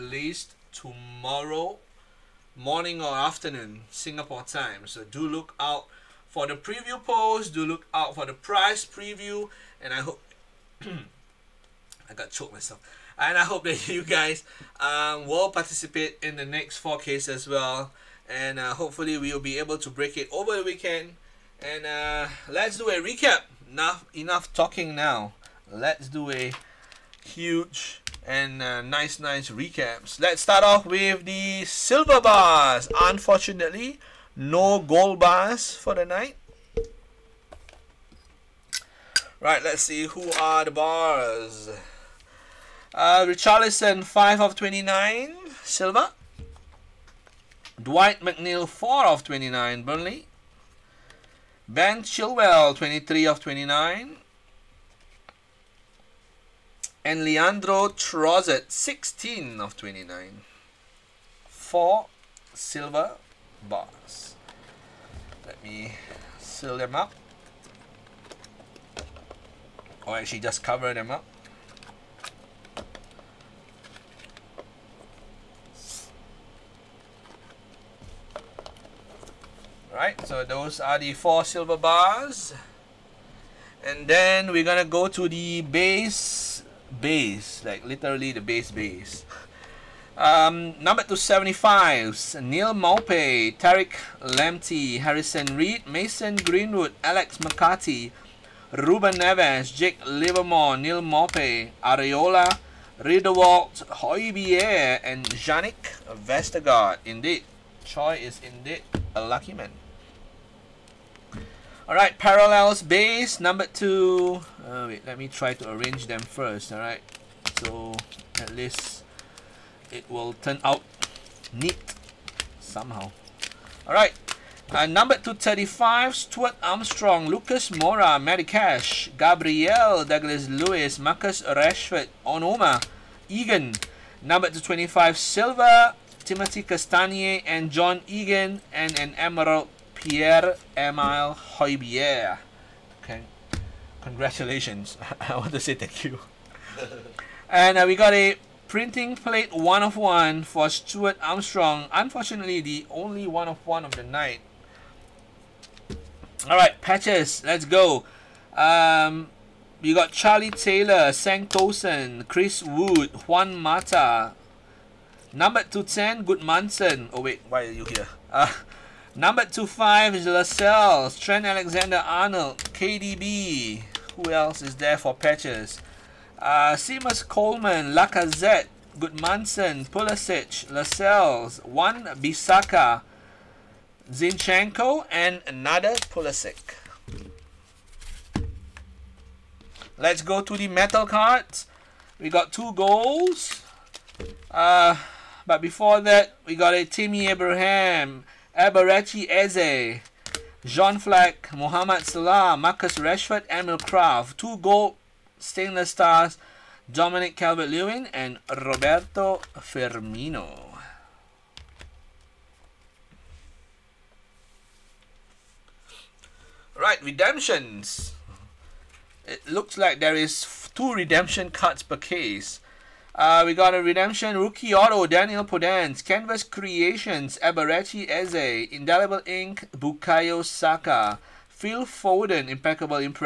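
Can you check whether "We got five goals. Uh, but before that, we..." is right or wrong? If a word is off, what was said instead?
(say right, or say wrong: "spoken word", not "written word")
wrong: "two", not "five".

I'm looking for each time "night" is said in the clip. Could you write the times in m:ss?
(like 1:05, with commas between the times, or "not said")
0:36, 2:34.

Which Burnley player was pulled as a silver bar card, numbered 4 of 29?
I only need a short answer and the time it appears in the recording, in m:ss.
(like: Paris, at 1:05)
Dwight McNeil, at 0:47.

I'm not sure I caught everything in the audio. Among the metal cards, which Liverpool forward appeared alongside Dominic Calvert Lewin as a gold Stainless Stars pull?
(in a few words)
Roberto Firmino.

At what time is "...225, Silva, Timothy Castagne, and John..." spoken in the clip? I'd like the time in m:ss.
2:14.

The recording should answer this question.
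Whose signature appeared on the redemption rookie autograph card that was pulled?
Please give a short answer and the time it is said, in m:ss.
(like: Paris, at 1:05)
Daniel Podence, at 3:45.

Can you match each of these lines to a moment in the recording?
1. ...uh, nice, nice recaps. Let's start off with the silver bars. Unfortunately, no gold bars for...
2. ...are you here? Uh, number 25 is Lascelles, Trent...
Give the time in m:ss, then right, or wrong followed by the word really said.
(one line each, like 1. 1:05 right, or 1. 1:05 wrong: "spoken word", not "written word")
1. 0:28 right
2. 2:47 right.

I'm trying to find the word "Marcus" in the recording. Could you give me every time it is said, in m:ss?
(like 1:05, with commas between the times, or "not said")
2:10, 3:22.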